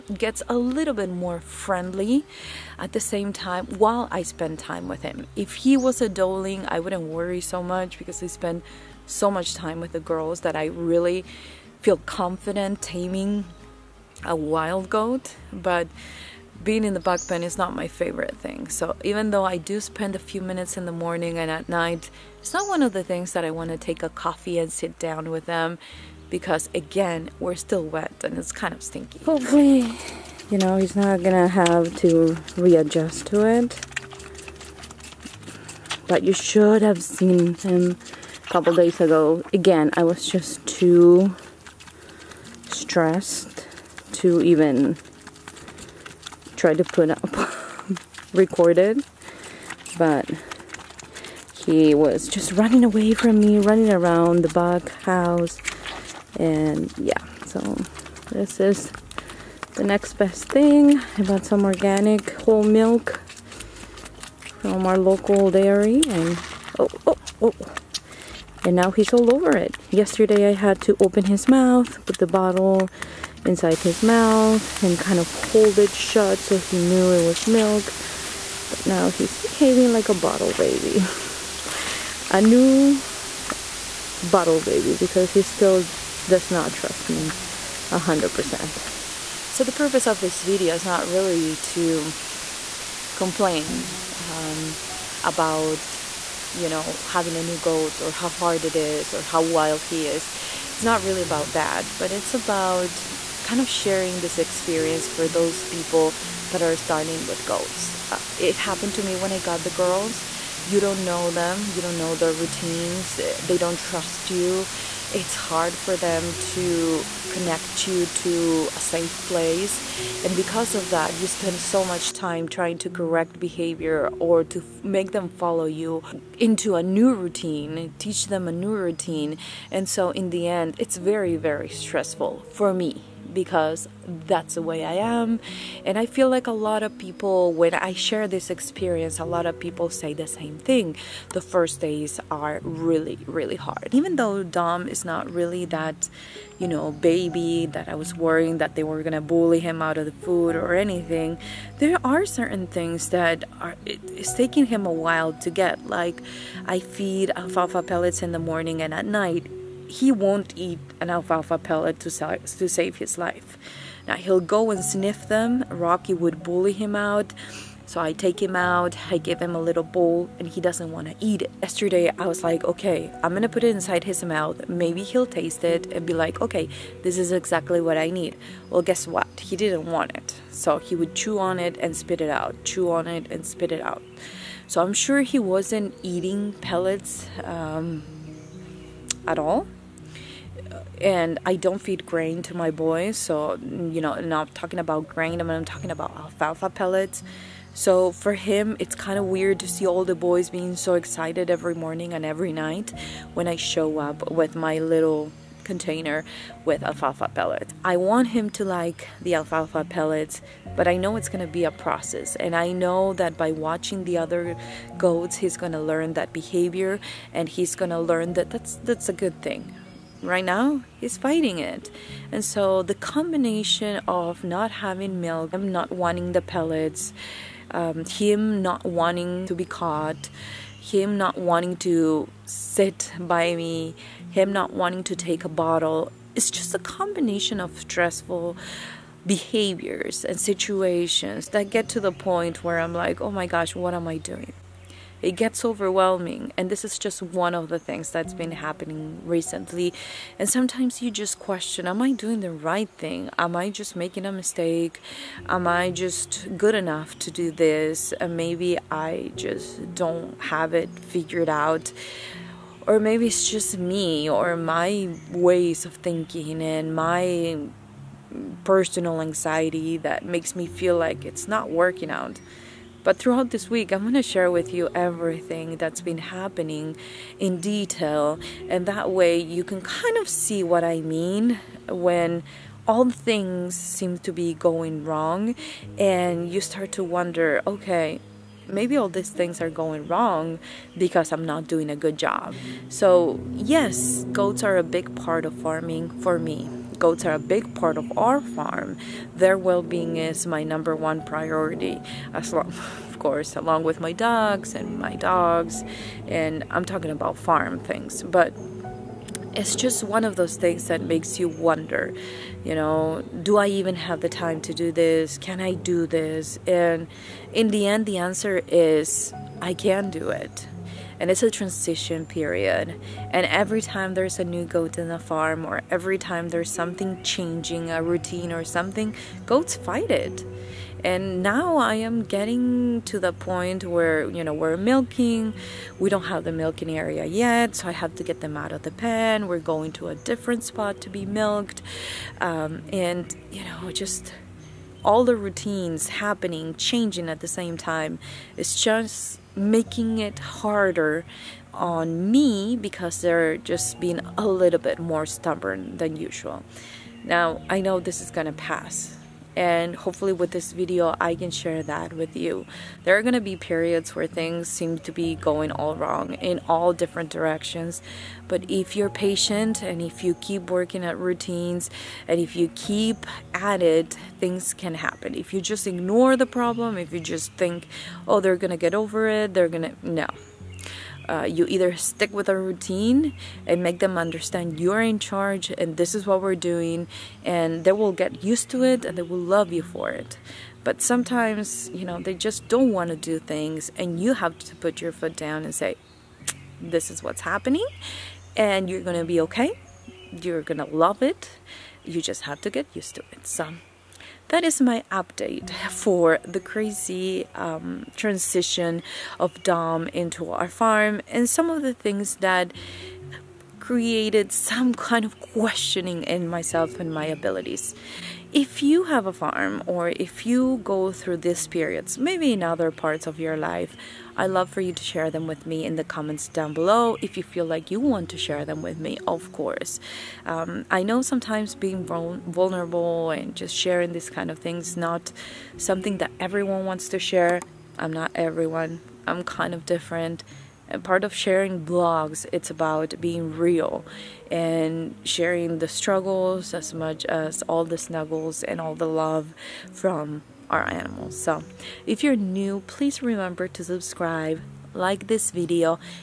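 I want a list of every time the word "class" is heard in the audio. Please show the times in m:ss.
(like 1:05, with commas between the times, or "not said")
not said.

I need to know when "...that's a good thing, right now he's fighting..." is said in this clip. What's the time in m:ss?
3:38.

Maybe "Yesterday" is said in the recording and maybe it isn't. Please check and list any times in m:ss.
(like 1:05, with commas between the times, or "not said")
1:09, 2:51.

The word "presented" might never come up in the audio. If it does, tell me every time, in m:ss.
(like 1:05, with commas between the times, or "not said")
not said.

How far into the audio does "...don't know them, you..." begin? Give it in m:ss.
1:50.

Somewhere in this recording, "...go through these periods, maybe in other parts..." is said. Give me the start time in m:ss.
7:00.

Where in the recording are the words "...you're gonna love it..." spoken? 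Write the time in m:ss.
6:40.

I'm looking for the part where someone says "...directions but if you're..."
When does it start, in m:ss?
6:07.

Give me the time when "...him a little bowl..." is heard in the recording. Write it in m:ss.
2:49.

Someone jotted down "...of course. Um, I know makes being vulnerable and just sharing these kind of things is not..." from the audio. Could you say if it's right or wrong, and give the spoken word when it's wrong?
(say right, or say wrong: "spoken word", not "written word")
wrong: "sometimes", not "makes".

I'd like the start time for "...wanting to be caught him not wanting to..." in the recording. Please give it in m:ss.
3:48.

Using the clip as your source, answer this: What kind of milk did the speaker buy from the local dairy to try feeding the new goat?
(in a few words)
Organic whole milk.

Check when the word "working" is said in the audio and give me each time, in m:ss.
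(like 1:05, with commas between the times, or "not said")
4:31, 6:10.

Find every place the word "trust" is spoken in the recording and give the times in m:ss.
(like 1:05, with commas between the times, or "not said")
1:26, 1:53.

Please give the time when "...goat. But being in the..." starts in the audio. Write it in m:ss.
0:14.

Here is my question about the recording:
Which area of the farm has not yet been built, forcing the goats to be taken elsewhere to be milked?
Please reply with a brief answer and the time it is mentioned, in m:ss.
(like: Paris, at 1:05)
The milking area, at 5:36.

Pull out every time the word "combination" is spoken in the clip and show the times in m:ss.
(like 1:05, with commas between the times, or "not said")
3:42, 3:56.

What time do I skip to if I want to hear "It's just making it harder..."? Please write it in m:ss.
5:48.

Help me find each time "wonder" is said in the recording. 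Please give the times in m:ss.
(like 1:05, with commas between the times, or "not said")
4:47, 5:11.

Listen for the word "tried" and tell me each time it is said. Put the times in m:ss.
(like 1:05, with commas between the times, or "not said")
0:46.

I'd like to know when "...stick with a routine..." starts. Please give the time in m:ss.
6:21.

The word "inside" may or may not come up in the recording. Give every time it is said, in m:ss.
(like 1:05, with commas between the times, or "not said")
1:13, 2:53.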